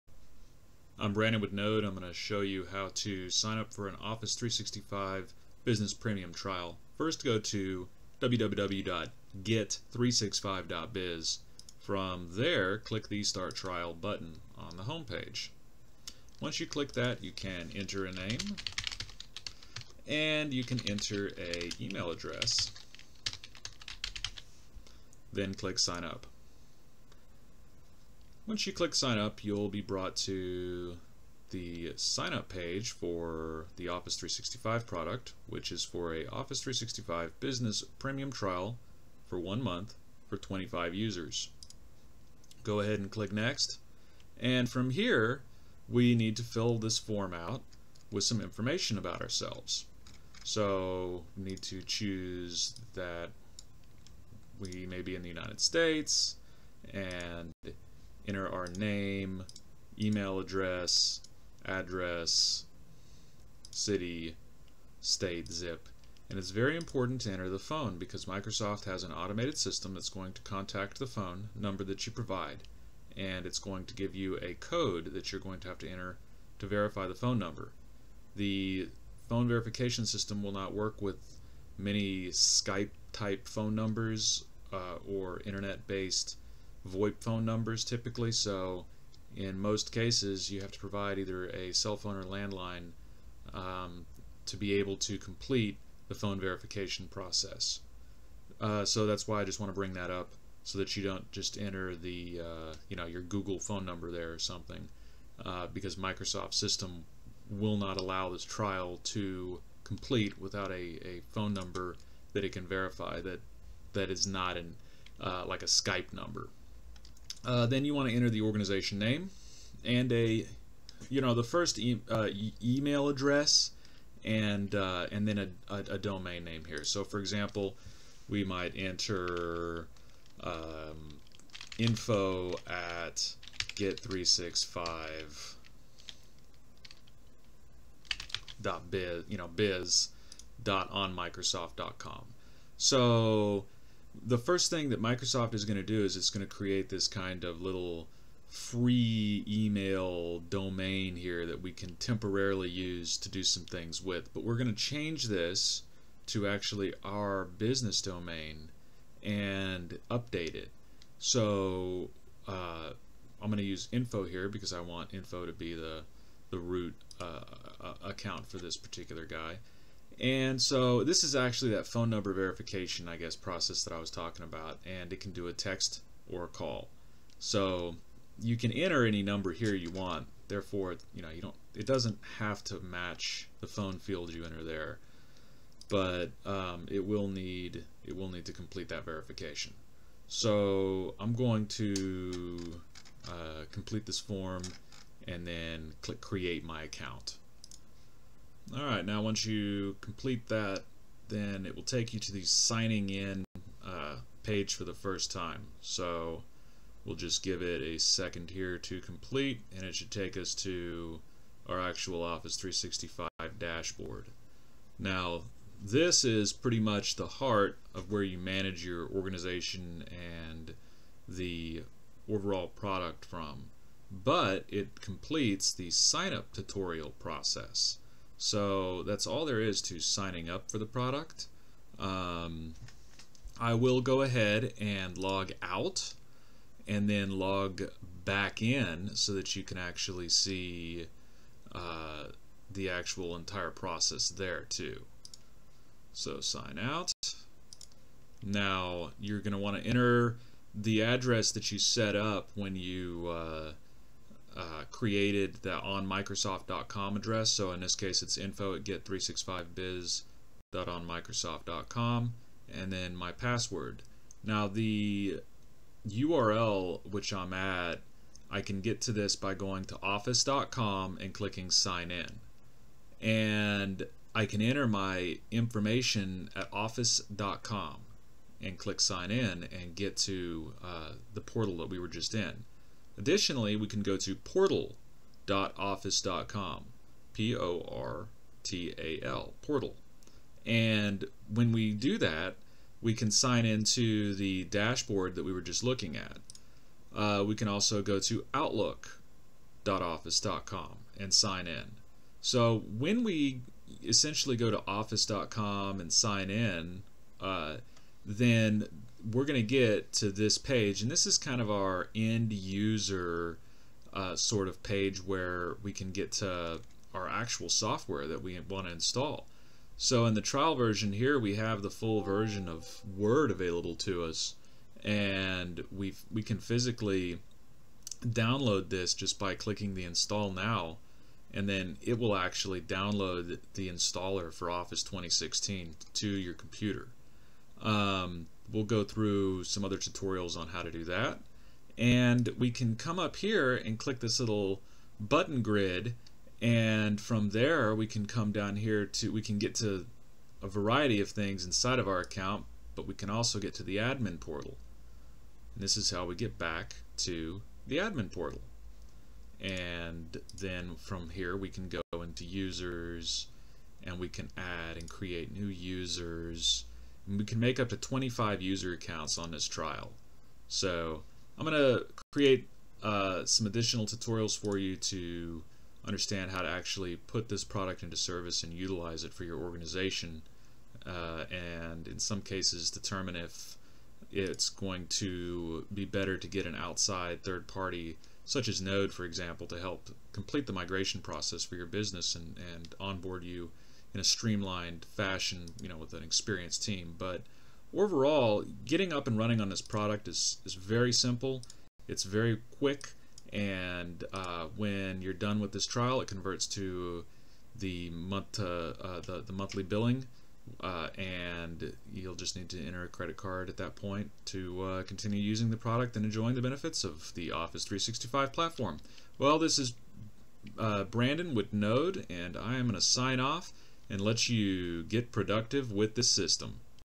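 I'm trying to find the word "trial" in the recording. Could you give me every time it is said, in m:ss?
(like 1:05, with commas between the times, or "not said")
0:06, 0:13, 0:38, 1:48, 5:20, 6:09, 6:45.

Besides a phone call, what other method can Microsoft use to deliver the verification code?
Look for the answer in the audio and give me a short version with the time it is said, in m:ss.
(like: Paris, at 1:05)
A text, at 2:55.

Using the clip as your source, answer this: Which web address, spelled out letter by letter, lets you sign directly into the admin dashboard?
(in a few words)
portal.office.com.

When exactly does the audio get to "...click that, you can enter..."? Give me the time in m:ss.
0:16.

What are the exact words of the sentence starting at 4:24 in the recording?
Now the URL which I'm at, I can get to this by going to office.com and clicking sign in.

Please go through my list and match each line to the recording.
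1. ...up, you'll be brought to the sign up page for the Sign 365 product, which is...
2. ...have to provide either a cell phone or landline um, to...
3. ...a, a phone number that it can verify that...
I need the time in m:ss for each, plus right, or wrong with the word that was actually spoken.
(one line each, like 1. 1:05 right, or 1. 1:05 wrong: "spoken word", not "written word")
1. 0:29 wrong: "Office", not "Sign"
2. 1:30 right
3. 1:50 right.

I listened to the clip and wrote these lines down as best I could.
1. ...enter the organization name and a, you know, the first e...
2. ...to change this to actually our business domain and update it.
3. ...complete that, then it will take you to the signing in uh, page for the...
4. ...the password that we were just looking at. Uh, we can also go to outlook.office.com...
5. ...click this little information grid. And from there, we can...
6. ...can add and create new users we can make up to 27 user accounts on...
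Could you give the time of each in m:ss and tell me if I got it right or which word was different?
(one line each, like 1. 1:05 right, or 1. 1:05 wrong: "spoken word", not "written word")
1. 1:58 right
2. 2:34 right
3. 3:19 right
4. 4:54 wrong: "dashboard", not "password"
5. 5:43 wrong: "button", not "information"
6. 6:04 wrong: "25", not "27".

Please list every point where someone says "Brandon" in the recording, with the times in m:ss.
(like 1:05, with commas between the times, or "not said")
0:01, 7:01.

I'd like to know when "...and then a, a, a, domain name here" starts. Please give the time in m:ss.
2:05.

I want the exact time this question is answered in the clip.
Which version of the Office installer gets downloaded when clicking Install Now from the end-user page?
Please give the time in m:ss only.
5:34.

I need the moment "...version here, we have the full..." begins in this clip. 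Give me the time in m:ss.
5:20.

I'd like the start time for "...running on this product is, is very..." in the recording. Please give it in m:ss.
6:39.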